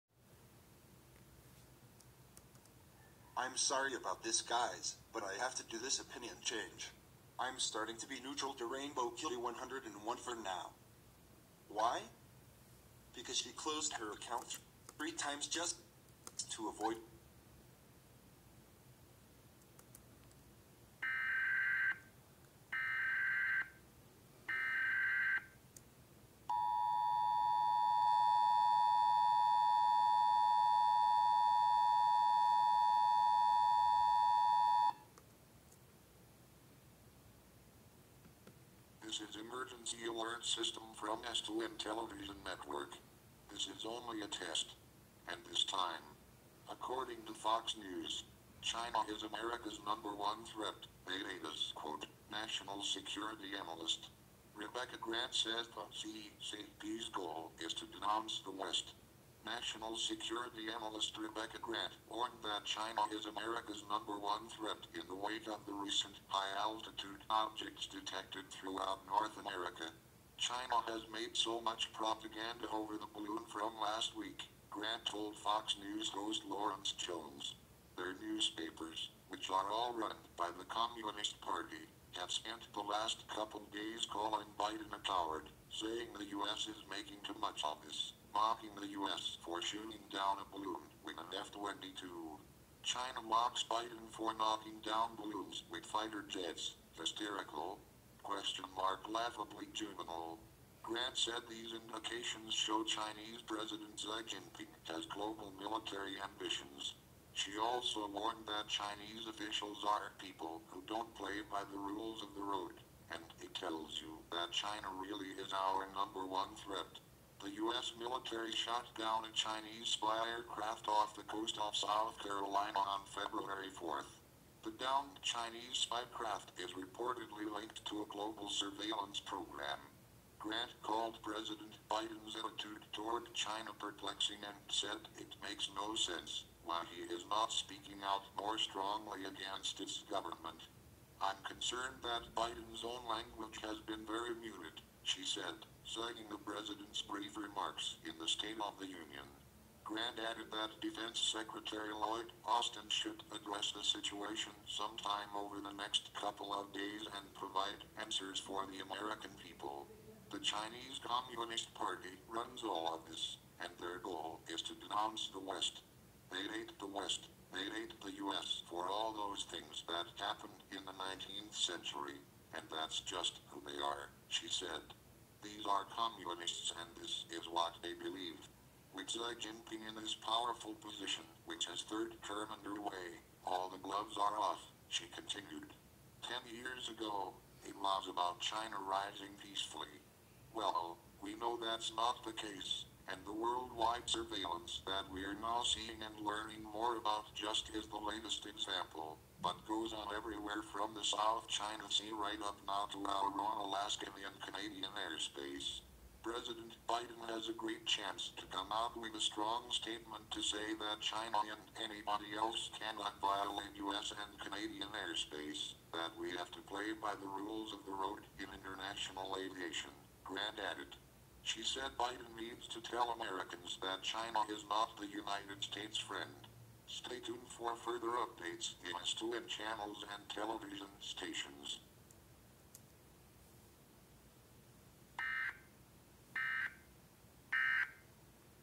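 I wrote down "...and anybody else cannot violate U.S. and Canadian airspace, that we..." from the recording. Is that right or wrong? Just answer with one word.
right.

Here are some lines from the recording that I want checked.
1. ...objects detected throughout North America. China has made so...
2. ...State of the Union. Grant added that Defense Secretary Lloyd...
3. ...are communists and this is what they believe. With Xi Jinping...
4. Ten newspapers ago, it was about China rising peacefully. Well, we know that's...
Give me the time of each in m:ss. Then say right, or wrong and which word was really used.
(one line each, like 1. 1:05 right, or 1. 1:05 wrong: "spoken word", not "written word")
1. 1:07 right
2. 2:28 right
3. 2:55 right
4. 3:06 wrong: "years", not "newspapers".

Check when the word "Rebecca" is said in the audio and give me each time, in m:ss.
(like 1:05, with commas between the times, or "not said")
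0:54, 1:01.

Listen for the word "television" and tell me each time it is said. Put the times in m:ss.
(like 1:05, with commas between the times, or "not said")
0:41, 3:50.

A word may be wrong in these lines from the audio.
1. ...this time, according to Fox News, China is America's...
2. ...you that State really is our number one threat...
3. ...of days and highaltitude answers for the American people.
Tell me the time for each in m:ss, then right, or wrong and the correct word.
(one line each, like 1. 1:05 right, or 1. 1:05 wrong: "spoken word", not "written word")
1. 0:45 right
2. 1:54 wrong: "China", not "State"
3. 2:36 wrong: "provide", not "highaltitude".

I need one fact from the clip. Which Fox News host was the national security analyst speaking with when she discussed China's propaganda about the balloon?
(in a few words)
Lawrence Jones.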